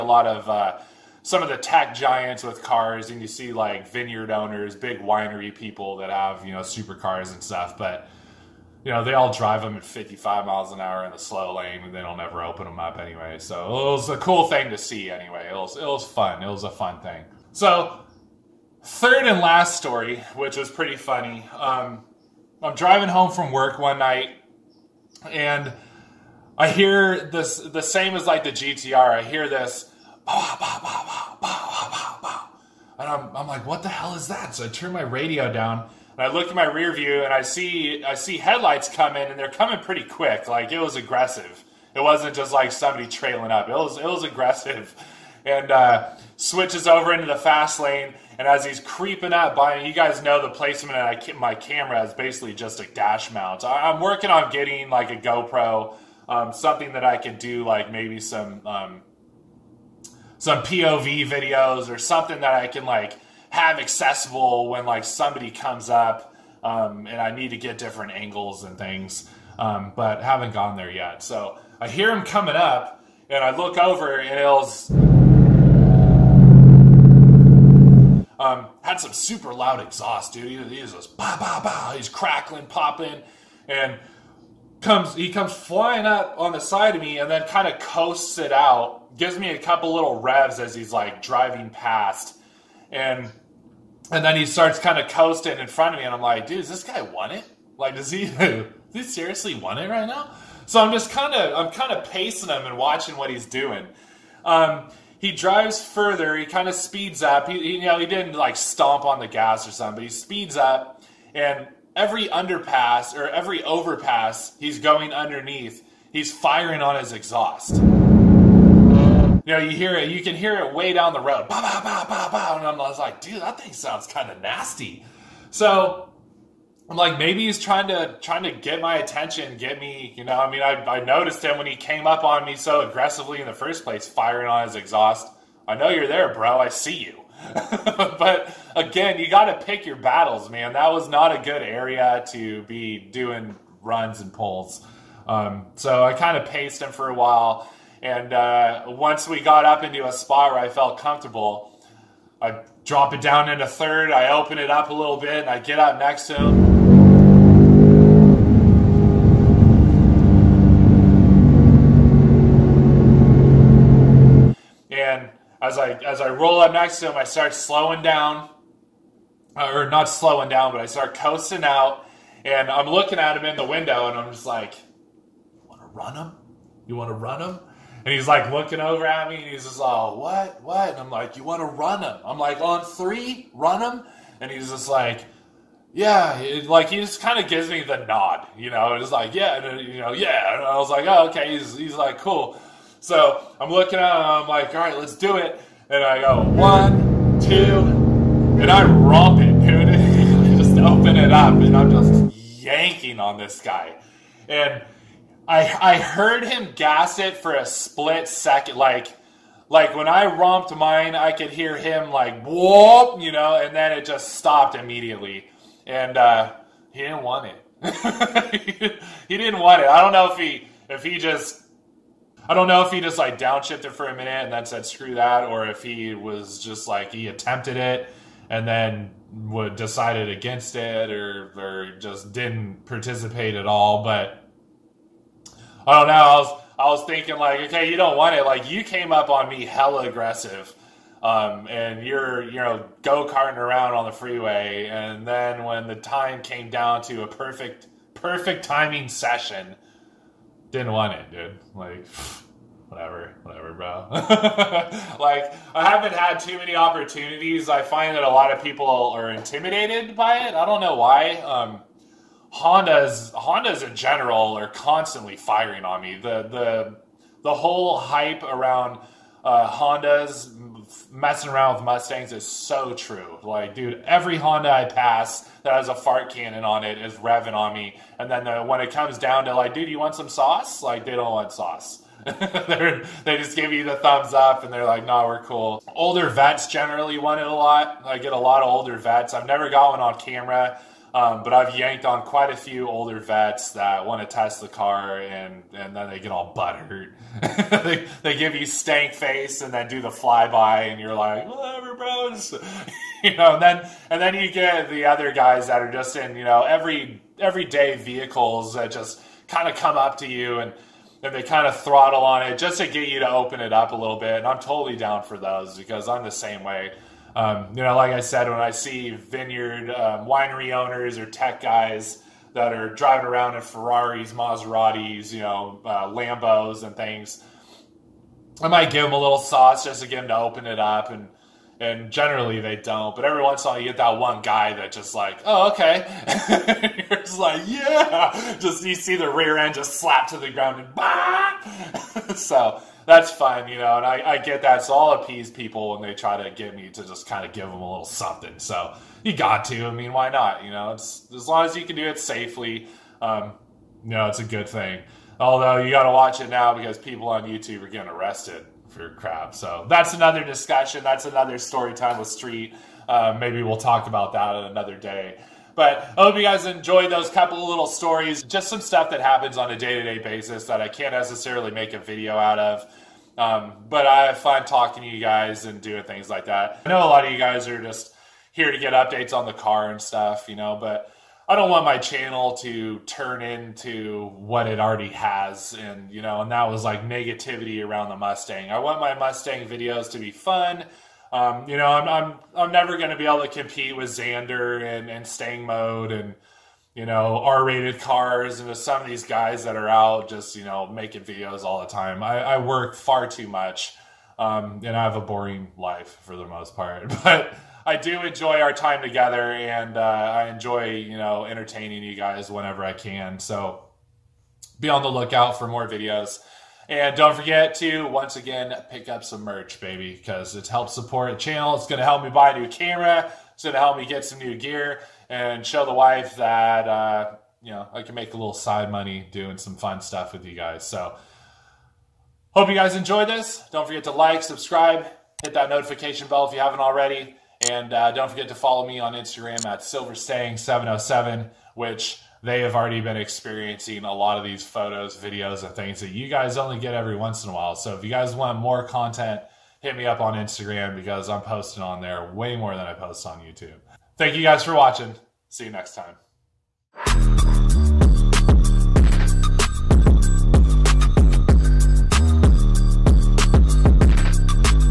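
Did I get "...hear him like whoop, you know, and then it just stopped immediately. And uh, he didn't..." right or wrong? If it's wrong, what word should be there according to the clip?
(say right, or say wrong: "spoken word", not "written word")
right.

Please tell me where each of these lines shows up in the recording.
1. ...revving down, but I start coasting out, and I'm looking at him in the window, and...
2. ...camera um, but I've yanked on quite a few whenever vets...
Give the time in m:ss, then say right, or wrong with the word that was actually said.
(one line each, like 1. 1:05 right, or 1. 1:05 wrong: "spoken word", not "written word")
1. 2:50 wrong: "slowing", not "revving"
2. 4:50 wrong: "older", not "whenever".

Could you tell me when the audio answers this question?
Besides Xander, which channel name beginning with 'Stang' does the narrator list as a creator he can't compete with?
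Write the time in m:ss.
6:35.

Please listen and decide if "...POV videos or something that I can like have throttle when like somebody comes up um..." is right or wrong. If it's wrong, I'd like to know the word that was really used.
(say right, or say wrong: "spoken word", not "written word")
wrong: "accessible", not "throttle".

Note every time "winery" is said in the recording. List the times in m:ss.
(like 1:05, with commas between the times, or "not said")
0:04, 5:20.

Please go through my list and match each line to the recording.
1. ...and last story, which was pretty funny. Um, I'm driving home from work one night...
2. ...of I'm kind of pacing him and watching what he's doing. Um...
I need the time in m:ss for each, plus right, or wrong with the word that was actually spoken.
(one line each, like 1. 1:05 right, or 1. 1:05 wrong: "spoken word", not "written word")
1. 0:19 right
2. 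1:41 right.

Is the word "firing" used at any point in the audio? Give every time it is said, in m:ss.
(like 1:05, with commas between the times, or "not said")
1:56, 2:14, 4:25.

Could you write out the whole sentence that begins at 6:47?
I do enjoy our time together, and uh, I enjoy you know entertaining you guys whenever I can.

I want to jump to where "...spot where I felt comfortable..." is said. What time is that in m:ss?
2:30.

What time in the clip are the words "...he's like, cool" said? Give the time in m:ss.
3:11.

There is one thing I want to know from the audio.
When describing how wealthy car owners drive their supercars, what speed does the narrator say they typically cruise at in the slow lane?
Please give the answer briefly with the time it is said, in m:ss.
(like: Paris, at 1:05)
55 miles an hour, at 0:09.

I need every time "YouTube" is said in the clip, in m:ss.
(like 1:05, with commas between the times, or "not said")
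5:57, 7:33.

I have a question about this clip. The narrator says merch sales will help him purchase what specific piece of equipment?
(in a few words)
new camera.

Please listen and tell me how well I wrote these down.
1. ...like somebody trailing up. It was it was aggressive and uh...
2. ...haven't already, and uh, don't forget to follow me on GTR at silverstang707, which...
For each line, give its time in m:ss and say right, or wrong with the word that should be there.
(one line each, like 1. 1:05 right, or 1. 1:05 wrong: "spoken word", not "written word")
1. 0:42 right
2. 7:16 wrong: "Instagram", not "GTR".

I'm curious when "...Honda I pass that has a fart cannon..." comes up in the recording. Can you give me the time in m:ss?
4:34.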